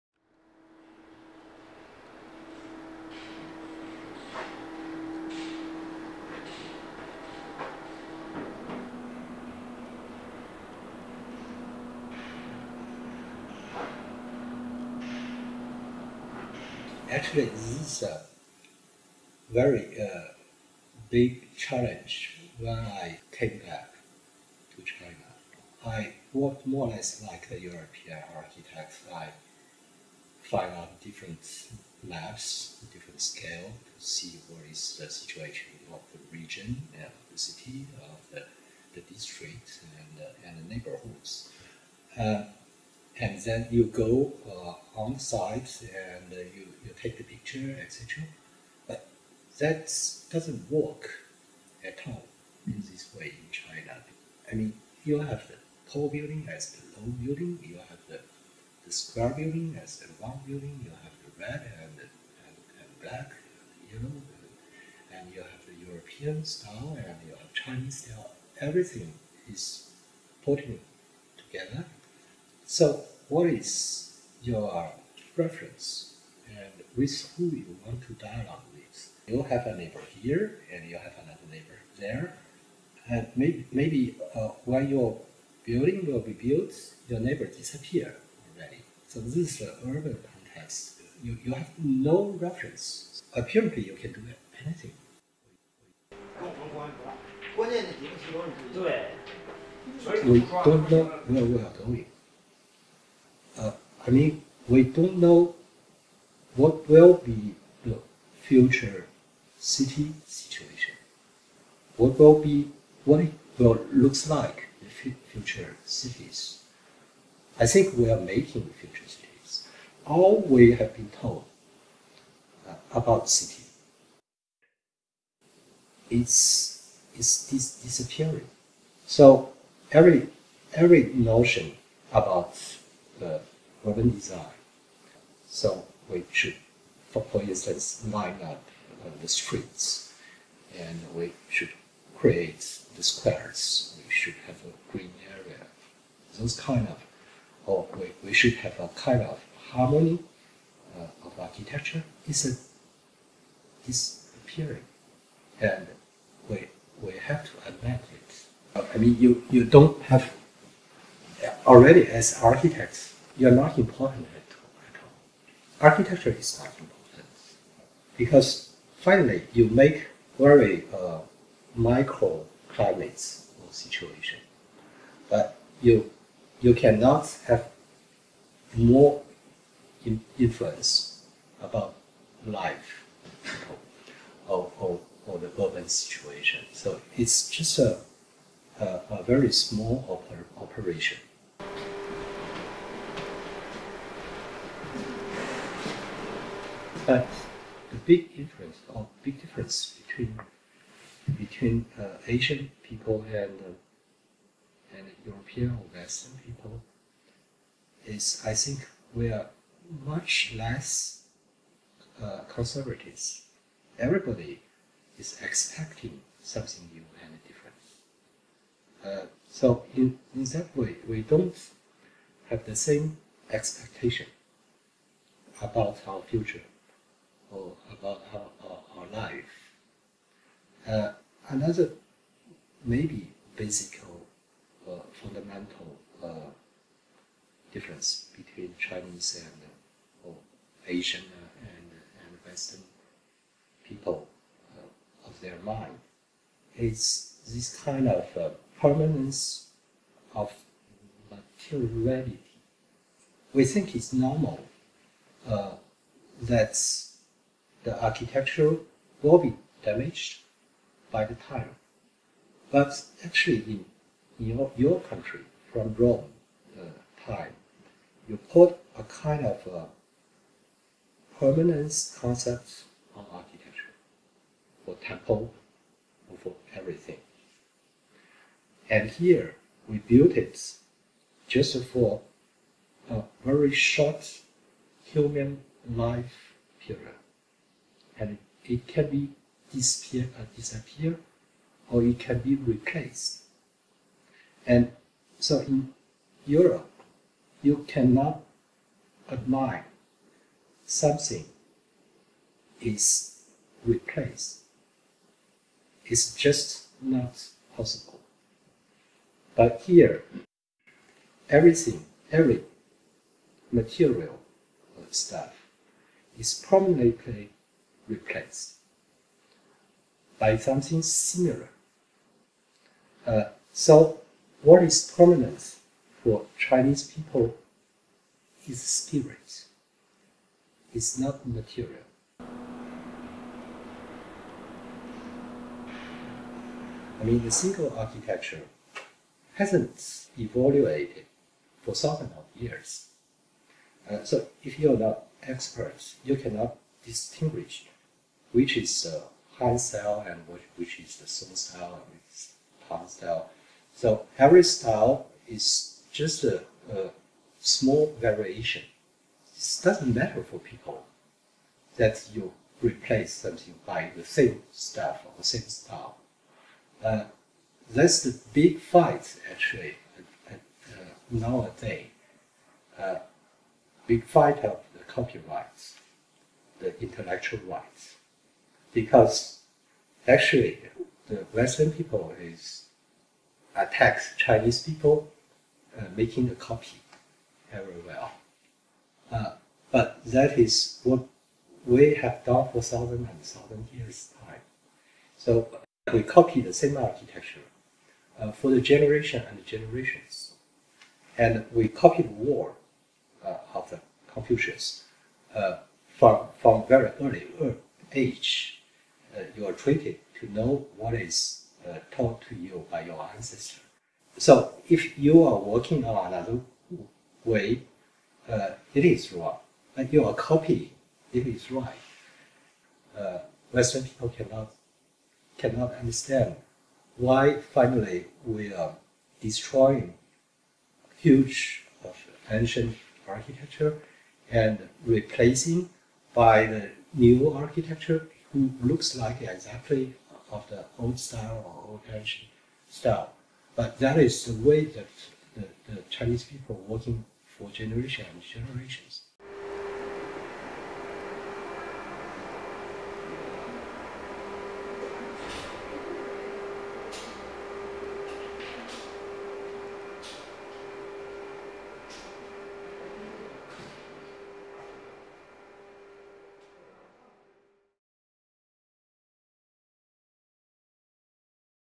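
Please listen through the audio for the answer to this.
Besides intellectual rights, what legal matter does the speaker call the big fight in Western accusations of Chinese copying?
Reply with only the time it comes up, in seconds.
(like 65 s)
375 s.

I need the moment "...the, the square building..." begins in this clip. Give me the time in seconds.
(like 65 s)
58 s.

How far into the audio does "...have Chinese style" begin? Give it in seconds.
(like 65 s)
67 s.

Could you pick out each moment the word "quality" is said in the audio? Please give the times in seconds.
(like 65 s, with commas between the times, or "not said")
not said.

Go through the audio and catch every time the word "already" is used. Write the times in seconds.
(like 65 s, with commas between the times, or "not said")
88 s, 161 s.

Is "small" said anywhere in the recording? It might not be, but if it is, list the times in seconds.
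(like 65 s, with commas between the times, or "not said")
189 s, 357 s.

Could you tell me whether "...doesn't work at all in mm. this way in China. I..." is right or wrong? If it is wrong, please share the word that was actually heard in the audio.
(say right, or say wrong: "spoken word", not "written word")
right.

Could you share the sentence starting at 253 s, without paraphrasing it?
We think it's normal that the architecture will be damaged by the time.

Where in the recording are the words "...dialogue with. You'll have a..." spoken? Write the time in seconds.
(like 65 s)
78 s.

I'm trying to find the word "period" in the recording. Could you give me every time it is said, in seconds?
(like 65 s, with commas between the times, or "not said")
286 s.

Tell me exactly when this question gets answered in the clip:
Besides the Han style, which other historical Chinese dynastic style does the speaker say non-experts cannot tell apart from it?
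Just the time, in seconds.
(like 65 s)
351 s.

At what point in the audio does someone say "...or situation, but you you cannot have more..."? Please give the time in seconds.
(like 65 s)
173 s.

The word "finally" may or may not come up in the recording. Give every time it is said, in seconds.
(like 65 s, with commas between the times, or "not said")
169 s, 427 s.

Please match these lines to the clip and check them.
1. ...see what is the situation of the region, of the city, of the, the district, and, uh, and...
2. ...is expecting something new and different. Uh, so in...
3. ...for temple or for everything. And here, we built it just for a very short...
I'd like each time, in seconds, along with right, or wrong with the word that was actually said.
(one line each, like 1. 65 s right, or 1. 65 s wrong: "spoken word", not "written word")
1. 34 s right
2. 215 s right
3. 274 s right.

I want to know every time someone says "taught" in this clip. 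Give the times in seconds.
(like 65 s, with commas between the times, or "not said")
412 s.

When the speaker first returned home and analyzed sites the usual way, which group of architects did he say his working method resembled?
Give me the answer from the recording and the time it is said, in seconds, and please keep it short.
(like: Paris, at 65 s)
European architects, at 27 s.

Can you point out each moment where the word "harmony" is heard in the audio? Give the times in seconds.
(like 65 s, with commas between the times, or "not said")
149 s.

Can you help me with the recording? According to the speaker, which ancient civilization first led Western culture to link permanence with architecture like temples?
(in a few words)
Rome.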